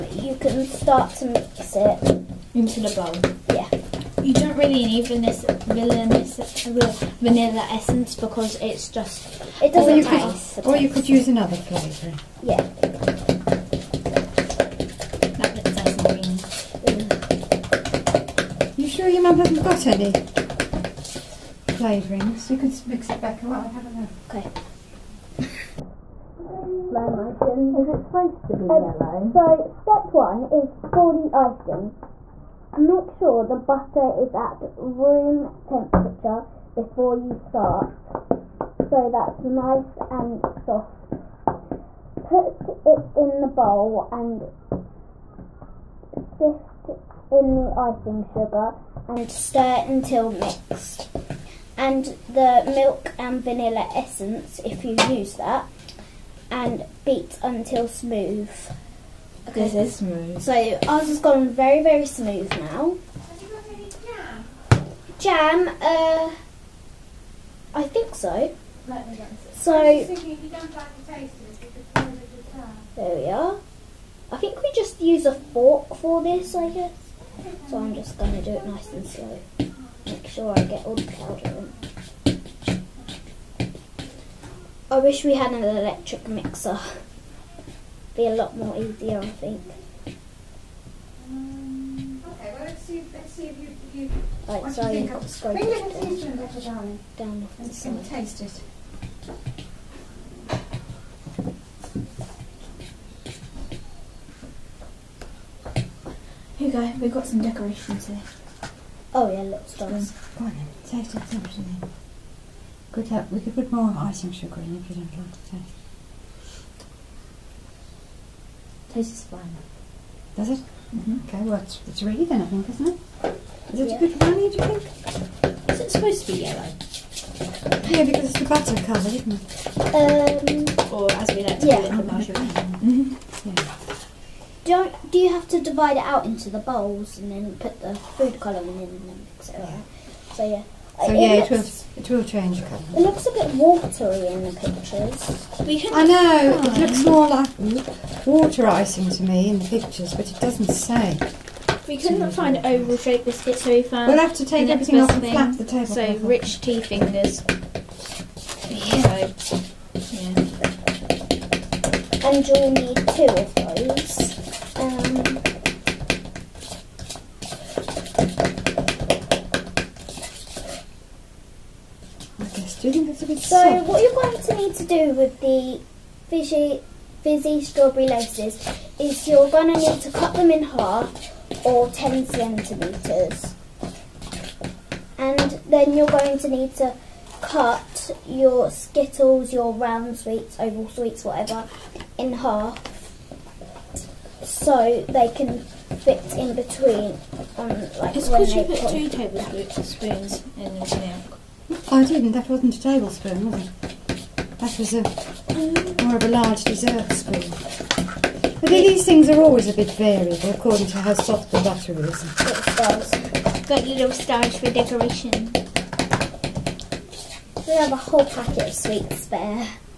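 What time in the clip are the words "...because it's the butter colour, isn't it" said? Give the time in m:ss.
2:08.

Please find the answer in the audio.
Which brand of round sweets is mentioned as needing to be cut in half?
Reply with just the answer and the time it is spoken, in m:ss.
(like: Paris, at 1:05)
Skittles, at 3:08.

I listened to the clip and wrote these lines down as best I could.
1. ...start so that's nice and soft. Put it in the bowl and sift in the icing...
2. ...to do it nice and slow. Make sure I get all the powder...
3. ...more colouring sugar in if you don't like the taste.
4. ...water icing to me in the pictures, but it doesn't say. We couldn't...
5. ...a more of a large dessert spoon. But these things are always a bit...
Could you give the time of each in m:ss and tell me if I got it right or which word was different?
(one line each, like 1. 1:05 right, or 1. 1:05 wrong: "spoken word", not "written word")
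1. 0:37 right
2. 1:18 right
3. 1:53 wrong: "icing", not "colouring"
4. 2:28 right
5. 3:24 right.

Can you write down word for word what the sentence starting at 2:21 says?
So it yeah, it, it it will change colour.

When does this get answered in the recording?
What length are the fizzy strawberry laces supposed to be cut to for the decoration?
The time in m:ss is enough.
3:01.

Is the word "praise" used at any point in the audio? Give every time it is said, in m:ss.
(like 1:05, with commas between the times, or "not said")
not said.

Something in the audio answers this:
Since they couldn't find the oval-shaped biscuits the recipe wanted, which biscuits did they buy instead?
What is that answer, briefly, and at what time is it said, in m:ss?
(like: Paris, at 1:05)
Rich tea fingers, at 2:36.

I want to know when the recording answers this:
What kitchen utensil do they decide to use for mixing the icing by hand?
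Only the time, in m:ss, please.
1:15.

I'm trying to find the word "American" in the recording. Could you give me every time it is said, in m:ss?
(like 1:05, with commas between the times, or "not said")
not said.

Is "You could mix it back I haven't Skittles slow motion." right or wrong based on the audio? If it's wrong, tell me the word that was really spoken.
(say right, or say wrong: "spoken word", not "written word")
wrong: "Okay", not "Skittles".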